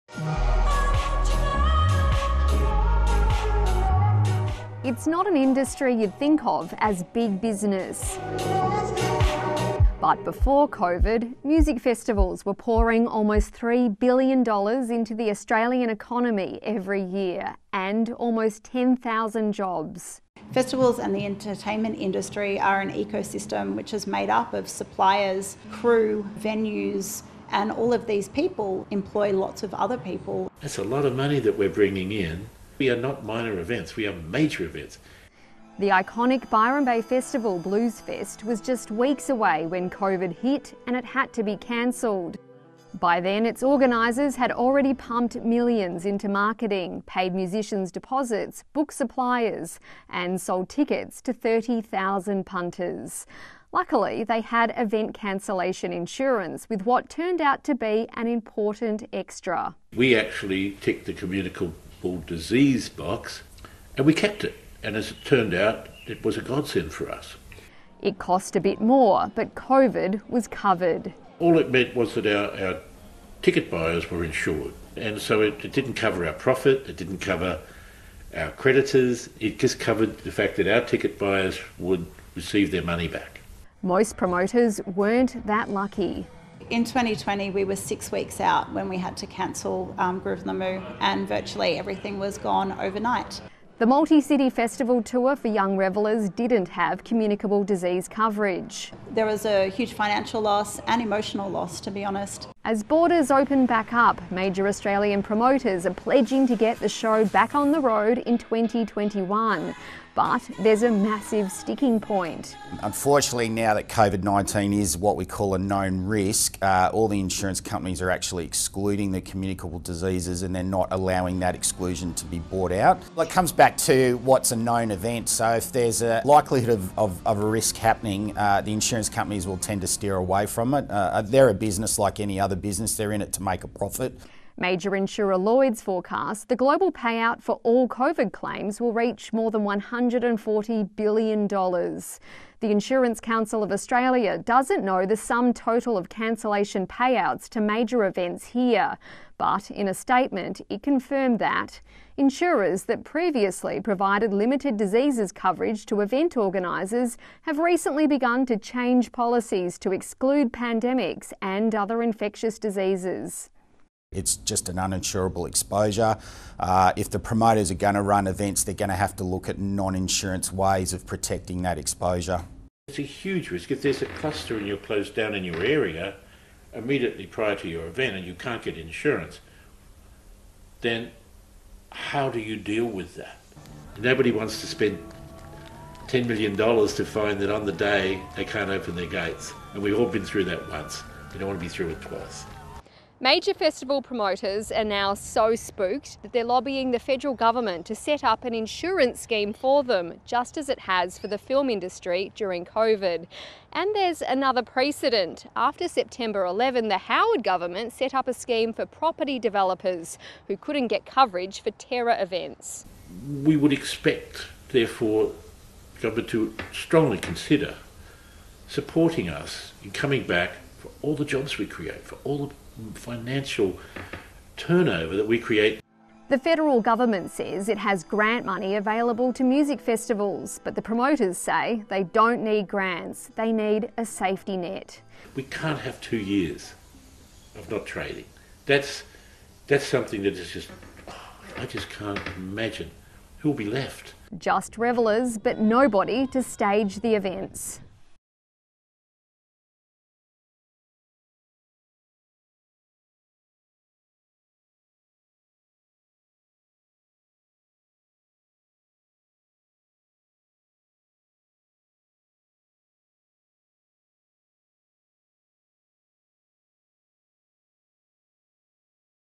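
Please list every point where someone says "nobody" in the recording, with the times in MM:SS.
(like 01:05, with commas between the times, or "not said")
03:03, 04:05.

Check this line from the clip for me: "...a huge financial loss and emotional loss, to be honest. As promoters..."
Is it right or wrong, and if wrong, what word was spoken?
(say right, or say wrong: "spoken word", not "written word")
wrong: "borders", not "promoters".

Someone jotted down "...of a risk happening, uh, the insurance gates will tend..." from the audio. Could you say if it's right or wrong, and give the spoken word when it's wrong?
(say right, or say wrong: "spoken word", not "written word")
wrong: "companies", not "gates".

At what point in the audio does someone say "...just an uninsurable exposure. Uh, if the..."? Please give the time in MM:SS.
02:44.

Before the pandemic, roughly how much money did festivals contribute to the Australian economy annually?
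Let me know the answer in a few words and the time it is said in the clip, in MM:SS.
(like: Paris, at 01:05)
almost $3 billion, at 00:13.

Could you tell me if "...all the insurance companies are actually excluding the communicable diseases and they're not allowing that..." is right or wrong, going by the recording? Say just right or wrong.
right.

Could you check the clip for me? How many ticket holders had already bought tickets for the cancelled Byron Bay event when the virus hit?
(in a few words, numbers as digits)
30,000.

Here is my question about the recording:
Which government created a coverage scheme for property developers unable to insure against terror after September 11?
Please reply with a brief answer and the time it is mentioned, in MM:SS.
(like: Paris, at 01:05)
the Howard government, at 03:26.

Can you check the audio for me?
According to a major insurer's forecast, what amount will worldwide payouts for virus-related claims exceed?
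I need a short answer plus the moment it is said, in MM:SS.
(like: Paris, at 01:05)
$140 billion, at 02:19.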